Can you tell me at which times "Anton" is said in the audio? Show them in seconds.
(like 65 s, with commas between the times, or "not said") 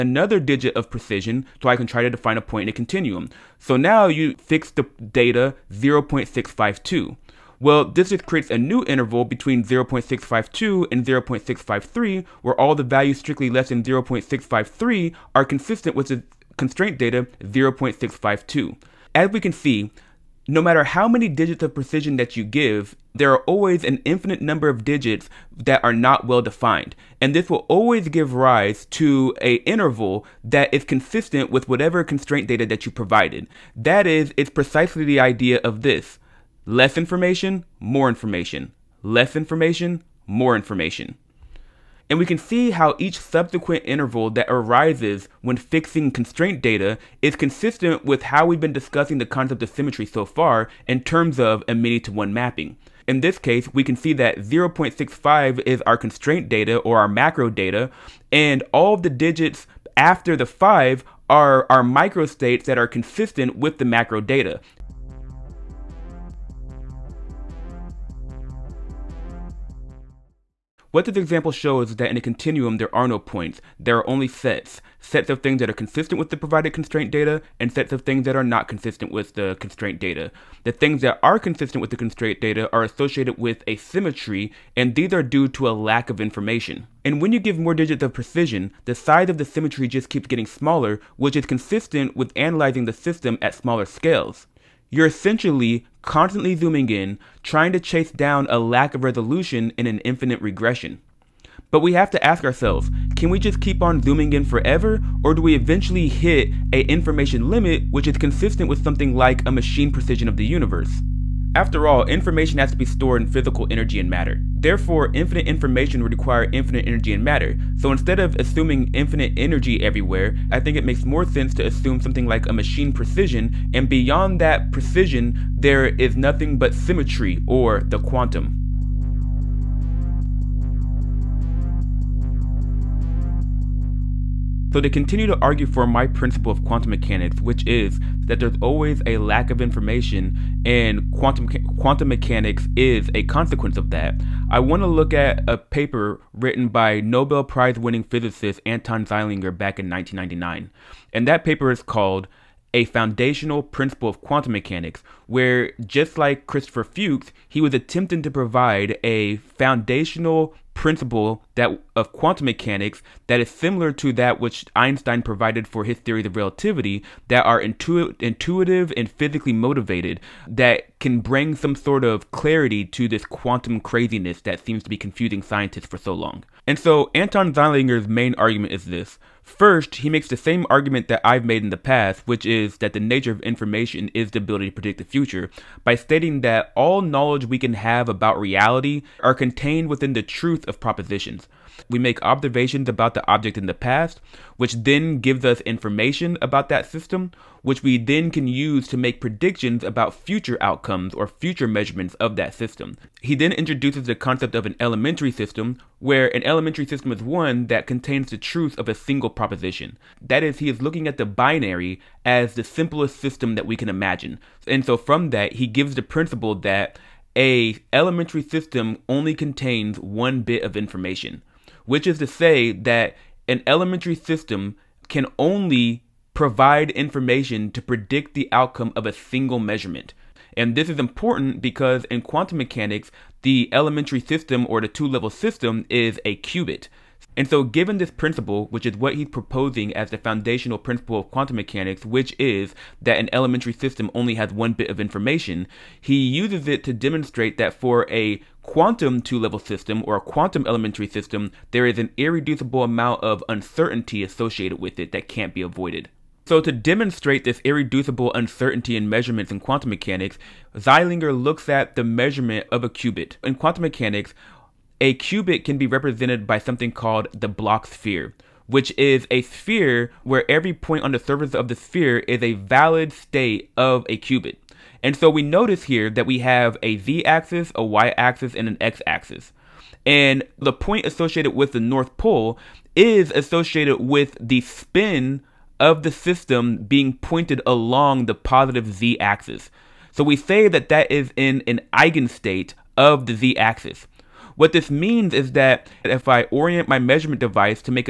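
148 s, 177 s.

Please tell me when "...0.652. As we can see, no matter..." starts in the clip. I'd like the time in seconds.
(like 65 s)
17 s.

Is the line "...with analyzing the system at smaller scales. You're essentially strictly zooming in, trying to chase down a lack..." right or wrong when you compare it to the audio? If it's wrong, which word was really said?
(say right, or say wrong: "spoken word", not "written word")
wrong: "constantly", not "strictly".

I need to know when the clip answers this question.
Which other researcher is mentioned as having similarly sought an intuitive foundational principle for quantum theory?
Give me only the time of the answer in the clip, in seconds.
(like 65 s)
156 s.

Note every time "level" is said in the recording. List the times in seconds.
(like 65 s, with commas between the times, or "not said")
235 s, 249 s.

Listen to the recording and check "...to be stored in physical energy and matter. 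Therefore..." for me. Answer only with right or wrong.
right.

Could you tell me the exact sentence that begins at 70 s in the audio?
What this example shows is that in a continuum, there are no points.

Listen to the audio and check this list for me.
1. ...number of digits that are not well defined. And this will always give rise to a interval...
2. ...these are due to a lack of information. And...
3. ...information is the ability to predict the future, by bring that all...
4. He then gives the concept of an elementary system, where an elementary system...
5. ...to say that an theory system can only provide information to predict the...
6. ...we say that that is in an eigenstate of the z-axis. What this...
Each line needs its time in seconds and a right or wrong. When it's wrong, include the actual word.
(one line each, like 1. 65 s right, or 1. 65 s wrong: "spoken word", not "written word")
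1. 24 s right
2. 84 s right
3. 183 s wrong: "stating", not "bring"
4. 203 s wrong: "introduces", not "gives"
5. 222 s wrong: "elementary", not "theory"
6. 290 s right.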